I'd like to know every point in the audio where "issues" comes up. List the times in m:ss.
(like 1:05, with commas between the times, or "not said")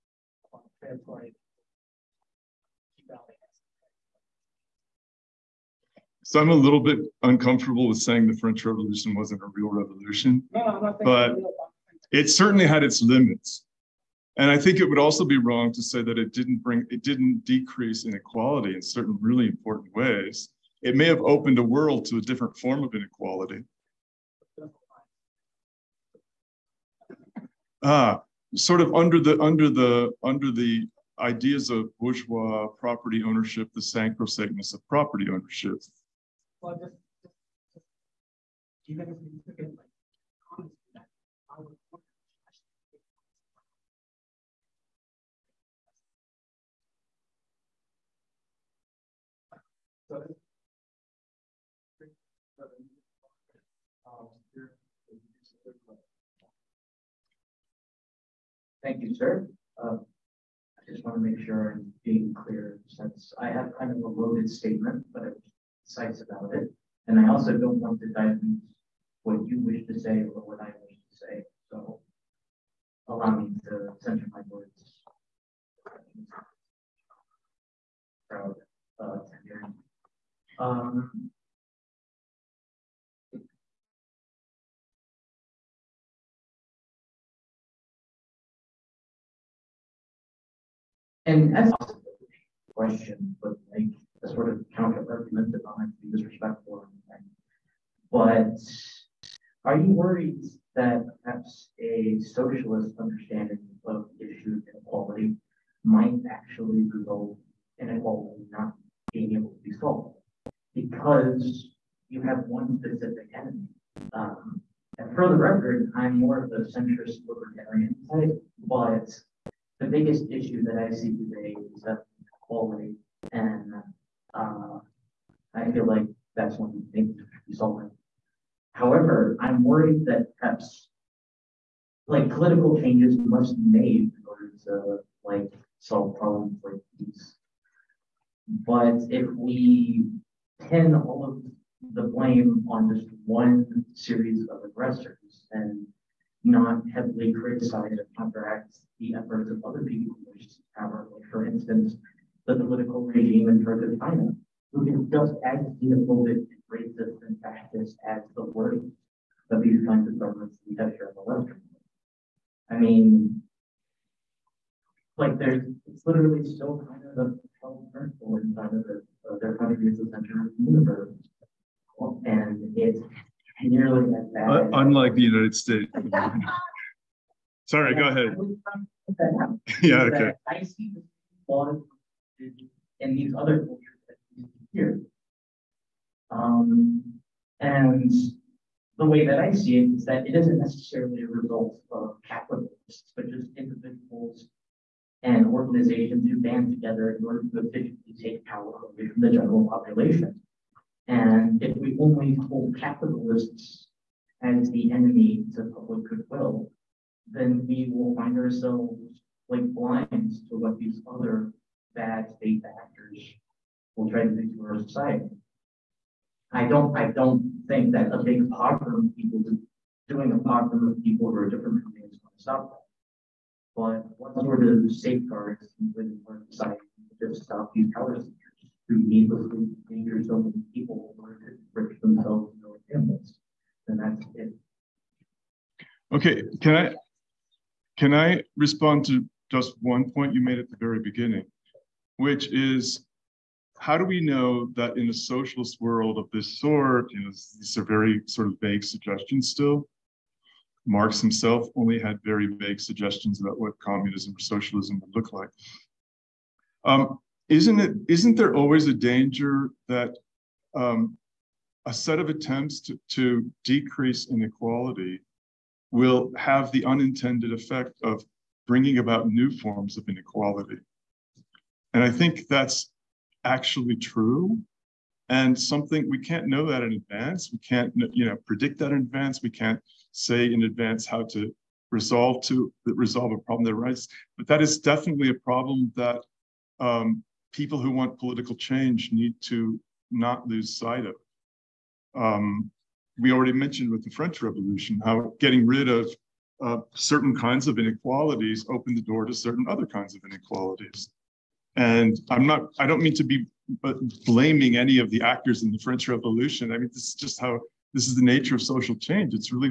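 1:44, 2:00.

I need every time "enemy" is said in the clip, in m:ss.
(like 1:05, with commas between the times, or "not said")
1:53, 3:24.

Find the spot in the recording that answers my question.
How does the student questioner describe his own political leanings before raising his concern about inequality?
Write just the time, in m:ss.
1:56.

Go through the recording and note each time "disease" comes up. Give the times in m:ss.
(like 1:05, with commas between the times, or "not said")
not said.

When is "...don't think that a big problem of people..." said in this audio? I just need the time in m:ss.
3:37.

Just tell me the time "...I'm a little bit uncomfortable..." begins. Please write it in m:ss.
0:06.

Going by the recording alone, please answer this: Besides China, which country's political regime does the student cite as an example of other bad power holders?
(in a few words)
Turkey.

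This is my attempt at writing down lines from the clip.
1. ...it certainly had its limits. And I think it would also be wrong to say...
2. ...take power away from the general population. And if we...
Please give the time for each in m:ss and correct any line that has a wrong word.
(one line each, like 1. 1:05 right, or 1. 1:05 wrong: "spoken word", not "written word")
1. 0:12 right
2. 3:18 right.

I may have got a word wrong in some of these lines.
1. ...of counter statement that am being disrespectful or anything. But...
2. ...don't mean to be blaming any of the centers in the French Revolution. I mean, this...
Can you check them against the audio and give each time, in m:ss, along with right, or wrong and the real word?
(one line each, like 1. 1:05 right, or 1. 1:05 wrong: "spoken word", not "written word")
1. 1:34 wrong: "argument", not "statement"
2. 5:02 wrong: "actors", not "centers".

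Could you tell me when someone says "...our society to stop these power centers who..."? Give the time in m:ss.
3:46.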